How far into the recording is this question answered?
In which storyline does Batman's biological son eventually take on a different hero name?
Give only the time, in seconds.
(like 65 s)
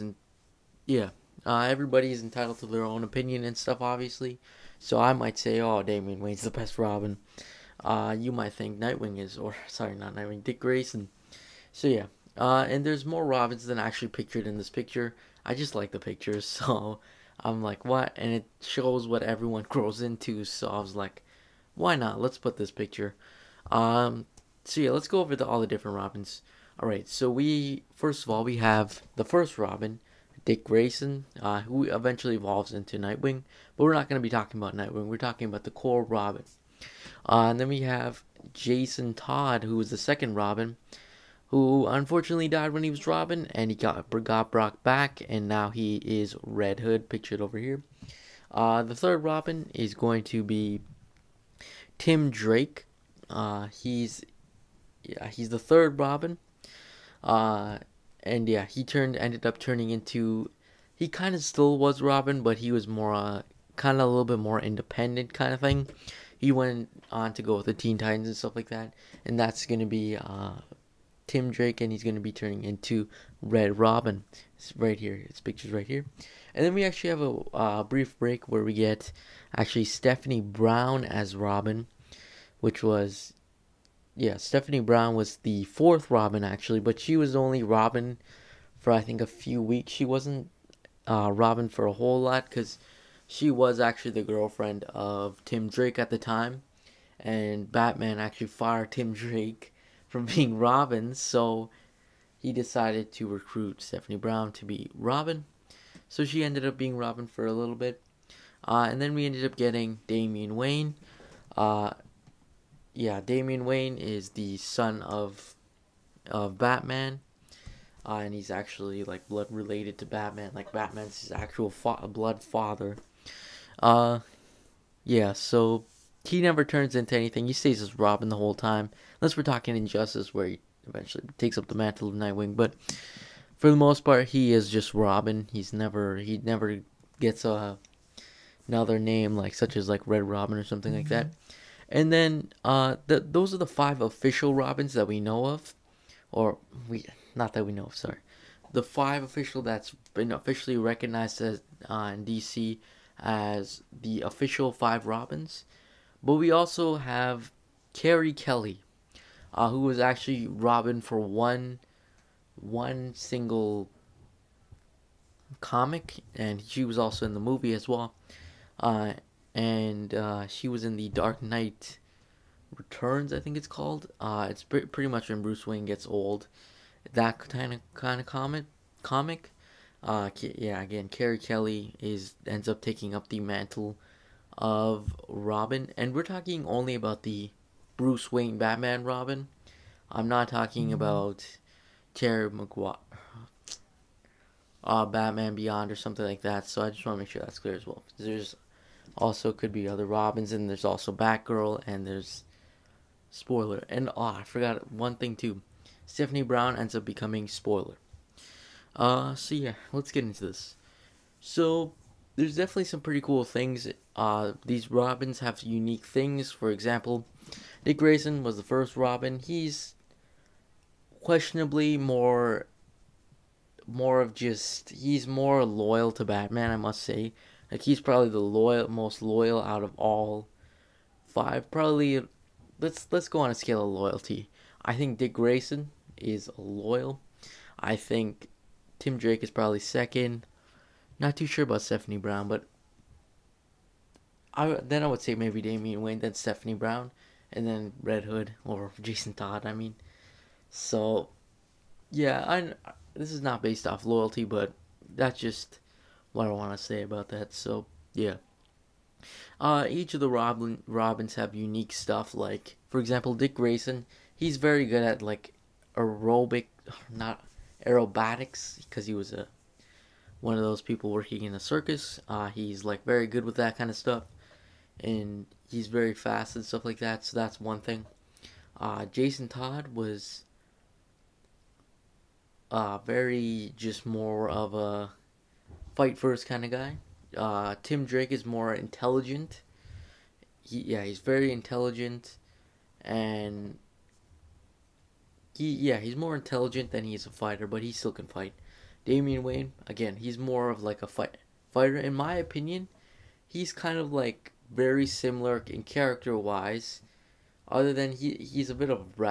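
129 s.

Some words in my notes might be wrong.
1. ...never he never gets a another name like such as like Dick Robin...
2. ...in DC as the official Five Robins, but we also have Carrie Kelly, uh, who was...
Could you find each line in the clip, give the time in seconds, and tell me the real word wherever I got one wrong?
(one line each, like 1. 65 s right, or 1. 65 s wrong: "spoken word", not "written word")
1. 135 s wrong: "Red", not "Dick"
2. 152 s right.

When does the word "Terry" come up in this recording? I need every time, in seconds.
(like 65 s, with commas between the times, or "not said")
192 s.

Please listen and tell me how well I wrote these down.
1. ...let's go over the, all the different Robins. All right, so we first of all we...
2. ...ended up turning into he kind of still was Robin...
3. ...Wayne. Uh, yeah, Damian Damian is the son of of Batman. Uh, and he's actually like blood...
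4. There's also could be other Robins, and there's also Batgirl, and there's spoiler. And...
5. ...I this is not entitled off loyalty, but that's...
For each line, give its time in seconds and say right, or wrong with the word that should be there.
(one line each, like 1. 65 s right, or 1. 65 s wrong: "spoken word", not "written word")
1. 24 s right
2. 59 s right
3. 110 s wrong: "Wayne", not "Damian"
4. 198 s right
5. 252 s wrong: "based", not "entitled".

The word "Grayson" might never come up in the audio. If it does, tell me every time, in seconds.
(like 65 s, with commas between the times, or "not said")
10 s, 30 s, 217 s, 235 s, 263 s.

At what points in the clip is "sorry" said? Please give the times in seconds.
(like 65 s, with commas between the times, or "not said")
9 s, 147 s.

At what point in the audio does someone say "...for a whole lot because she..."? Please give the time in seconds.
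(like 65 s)
91 s.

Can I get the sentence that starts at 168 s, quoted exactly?
Uh, and uh, she was in the Dark Knight Returns, I think it's called.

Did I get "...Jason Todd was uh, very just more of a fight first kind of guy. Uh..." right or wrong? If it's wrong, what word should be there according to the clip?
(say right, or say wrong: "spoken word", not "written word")
right.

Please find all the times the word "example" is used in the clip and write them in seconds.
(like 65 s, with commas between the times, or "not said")
216 s, 262 s.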